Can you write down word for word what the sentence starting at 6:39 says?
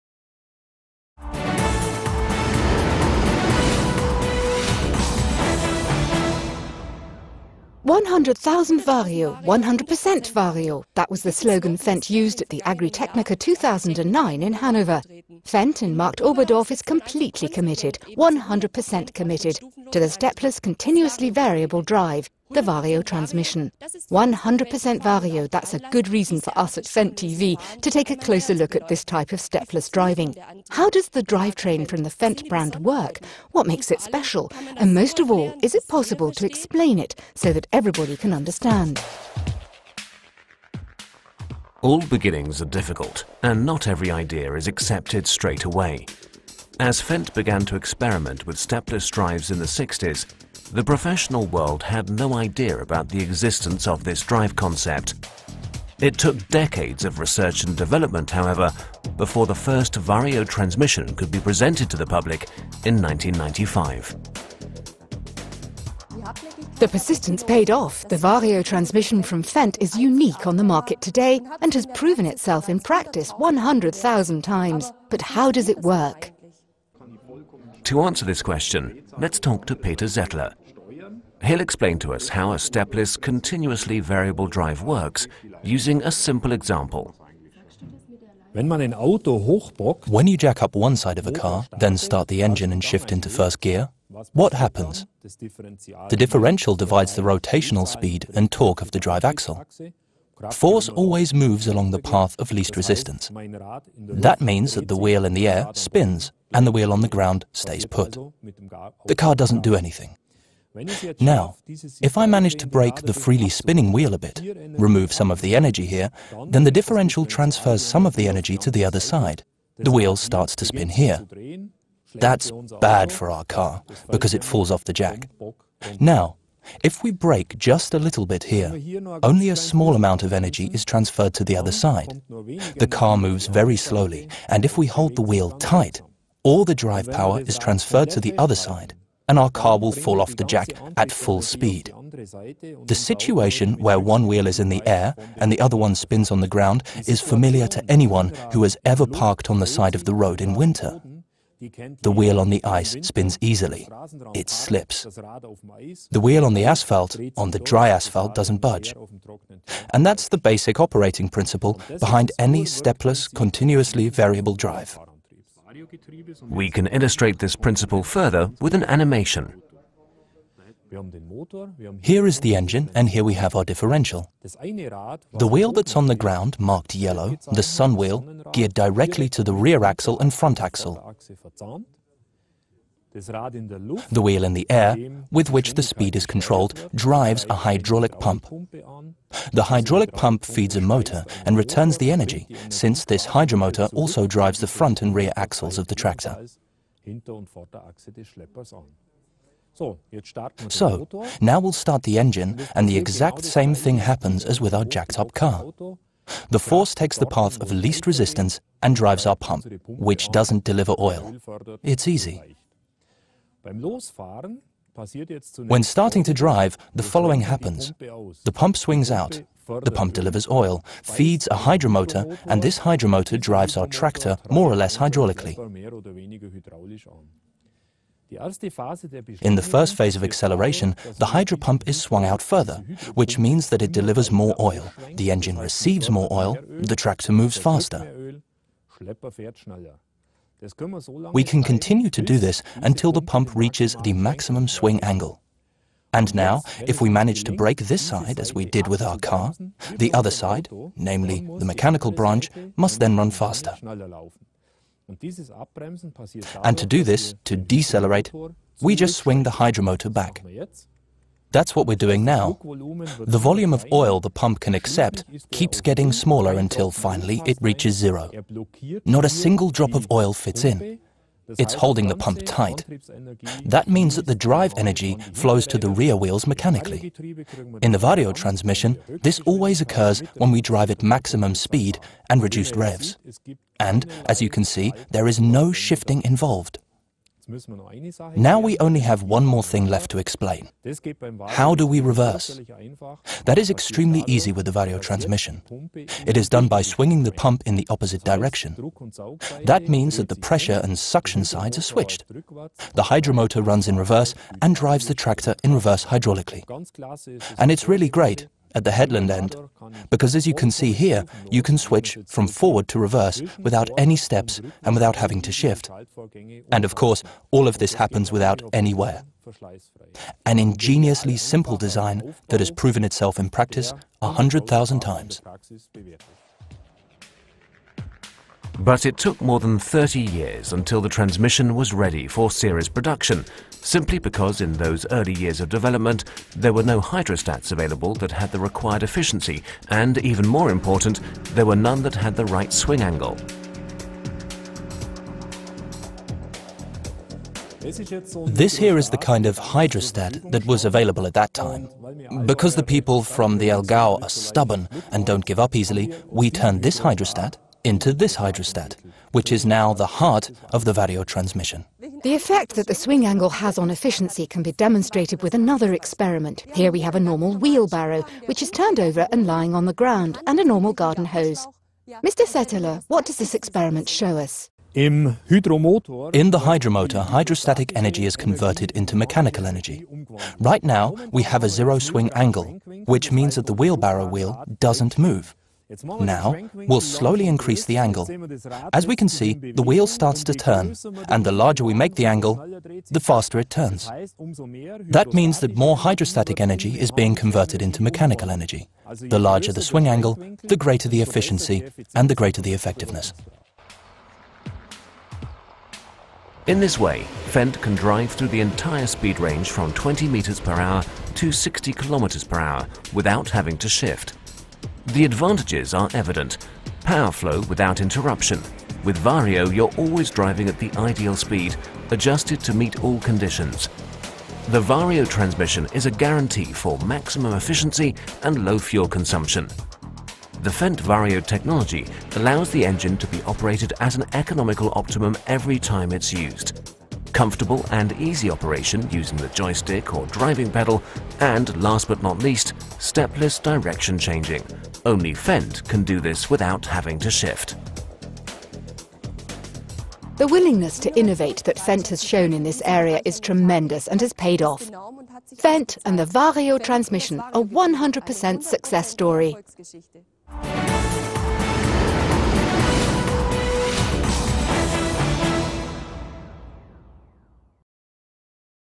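The larger the swing angle, the greater the efficiency and the greater the effectiveness.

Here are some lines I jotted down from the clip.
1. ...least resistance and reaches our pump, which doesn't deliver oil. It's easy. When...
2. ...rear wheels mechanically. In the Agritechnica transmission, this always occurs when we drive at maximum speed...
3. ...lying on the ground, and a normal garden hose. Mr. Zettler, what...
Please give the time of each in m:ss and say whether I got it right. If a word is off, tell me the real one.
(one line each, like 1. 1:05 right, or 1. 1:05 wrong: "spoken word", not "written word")
1. 3:27 wrong: "drives", not "reaches"
2. 4:35 wrong: "Vario", not "Agritechnica"
3. 6:09 right.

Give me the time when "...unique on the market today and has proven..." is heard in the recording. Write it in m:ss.
1:09.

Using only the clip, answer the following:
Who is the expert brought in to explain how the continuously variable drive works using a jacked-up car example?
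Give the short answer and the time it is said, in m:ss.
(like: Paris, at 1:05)
Peter Zettler, at 1:19.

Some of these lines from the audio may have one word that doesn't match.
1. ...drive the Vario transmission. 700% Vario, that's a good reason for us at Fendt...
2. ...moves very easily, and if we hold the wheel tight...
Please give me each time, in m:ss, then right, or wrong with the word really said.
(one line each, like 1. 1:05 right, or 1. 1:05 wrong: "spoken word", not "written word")
1. 0:21 wrong: "100", not "700"
2. 2:13 wrong: "slowly", not "easily".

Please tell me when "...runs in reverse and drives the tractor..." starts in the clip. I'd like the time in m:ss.
5:03.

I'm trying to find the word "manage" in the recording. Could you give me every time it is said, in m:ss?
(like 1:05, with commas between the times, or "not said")
1:52, 4:07.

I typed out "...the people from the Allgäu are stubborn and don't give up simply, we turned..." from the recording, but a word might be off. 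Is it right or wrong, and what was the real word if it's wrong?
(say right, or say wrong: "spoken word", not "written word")
wrong: "easily", not "simply".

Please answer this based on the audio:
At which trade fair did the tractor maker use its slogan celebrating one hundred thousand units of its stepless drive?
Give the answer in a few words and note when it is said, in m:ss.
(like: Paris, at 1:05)
Agritechnica 2009, at 0:12.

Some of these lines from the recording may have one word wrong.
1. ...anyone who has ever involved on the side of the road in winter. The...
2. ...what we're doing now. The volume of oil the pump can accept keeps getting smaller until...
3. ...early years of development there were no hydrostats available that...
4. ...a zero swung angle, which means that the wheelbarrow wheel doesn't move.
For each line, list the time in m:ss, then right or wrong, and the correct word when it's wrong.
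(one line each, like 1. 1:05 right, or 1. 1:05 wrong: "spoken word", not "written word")
1. 2:27 wrong: "parked", not "involved"
2. 4:21 right
3. 5:35 right
4. 6:21 wrong: "swing", not "swung".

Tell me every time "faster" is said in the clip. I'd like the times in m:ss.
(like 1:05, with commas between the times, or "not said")
3:57, 4:13, 6:33.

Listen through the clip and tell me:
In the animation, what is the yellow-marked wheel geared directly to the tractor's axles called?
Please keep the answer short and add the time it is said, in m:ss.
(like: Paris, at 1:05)
sun wheel, at 2:57.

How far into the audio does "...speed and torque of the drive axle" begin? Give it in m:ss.
1:37.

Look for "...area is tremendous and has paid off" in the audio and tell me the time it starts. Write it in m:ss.
7:32.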